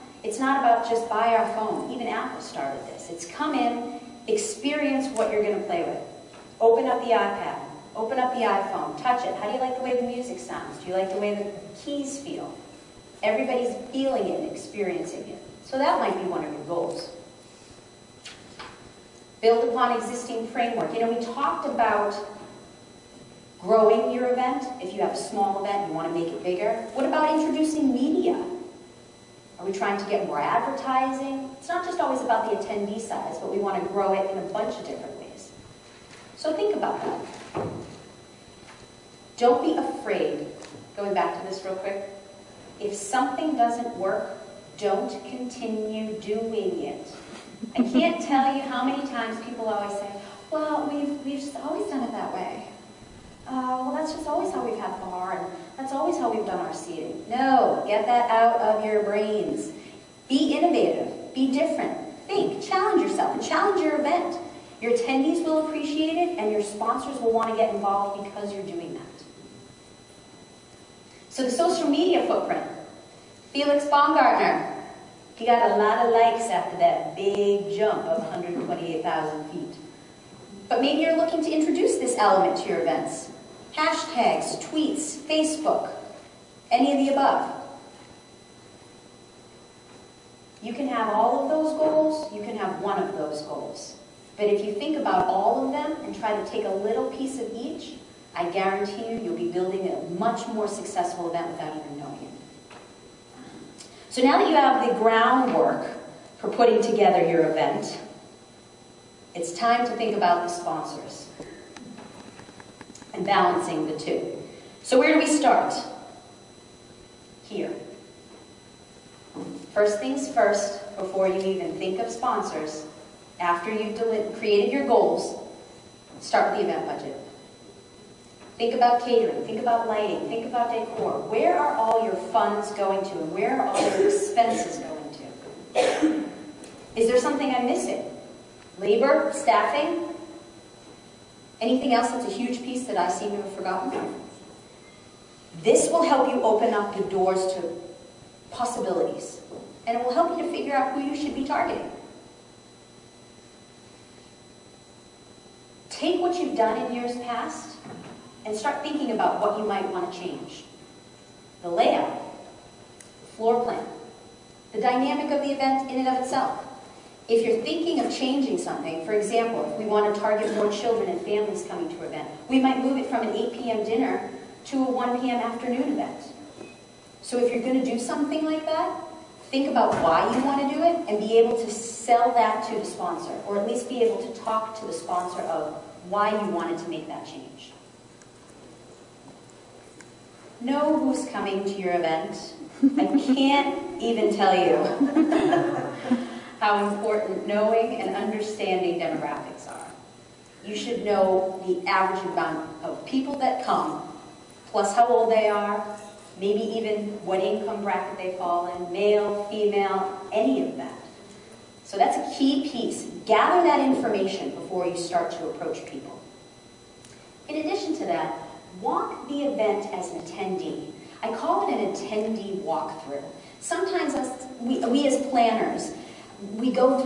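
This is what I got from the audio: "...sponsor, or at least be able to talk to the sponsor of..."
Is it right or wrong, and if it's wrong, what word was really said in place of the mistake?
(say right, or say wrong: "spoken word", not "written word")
right.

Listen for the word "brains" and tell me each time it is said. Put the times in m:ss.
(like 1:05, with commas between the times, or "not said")
0:59.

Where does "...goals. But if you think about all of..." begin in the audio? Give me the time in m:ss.
1:33.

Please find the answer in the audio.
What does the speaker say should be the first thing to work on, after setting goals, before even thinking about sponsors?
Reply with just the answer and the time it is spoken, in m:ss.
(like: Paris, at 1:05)
event budget, at 2:06.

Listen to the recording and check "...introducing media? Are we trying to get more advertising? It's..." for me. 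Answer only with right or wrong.
right.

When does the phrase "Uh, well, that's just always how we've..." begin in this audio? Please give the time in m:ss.
0:53.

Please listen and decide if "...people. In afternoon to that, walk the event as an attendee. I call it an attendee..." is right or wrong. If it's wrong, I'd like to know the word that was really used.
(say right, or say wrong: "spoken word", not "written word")
wrong: "addition", not "afternoon".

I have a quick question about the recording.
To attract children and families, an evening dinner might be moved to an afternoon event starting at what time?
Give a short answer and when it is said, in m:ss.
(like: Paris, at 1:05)
1 p.m., at 2:54.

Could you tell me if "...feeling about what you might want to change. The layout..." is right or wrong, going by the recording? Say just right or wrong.
wrong.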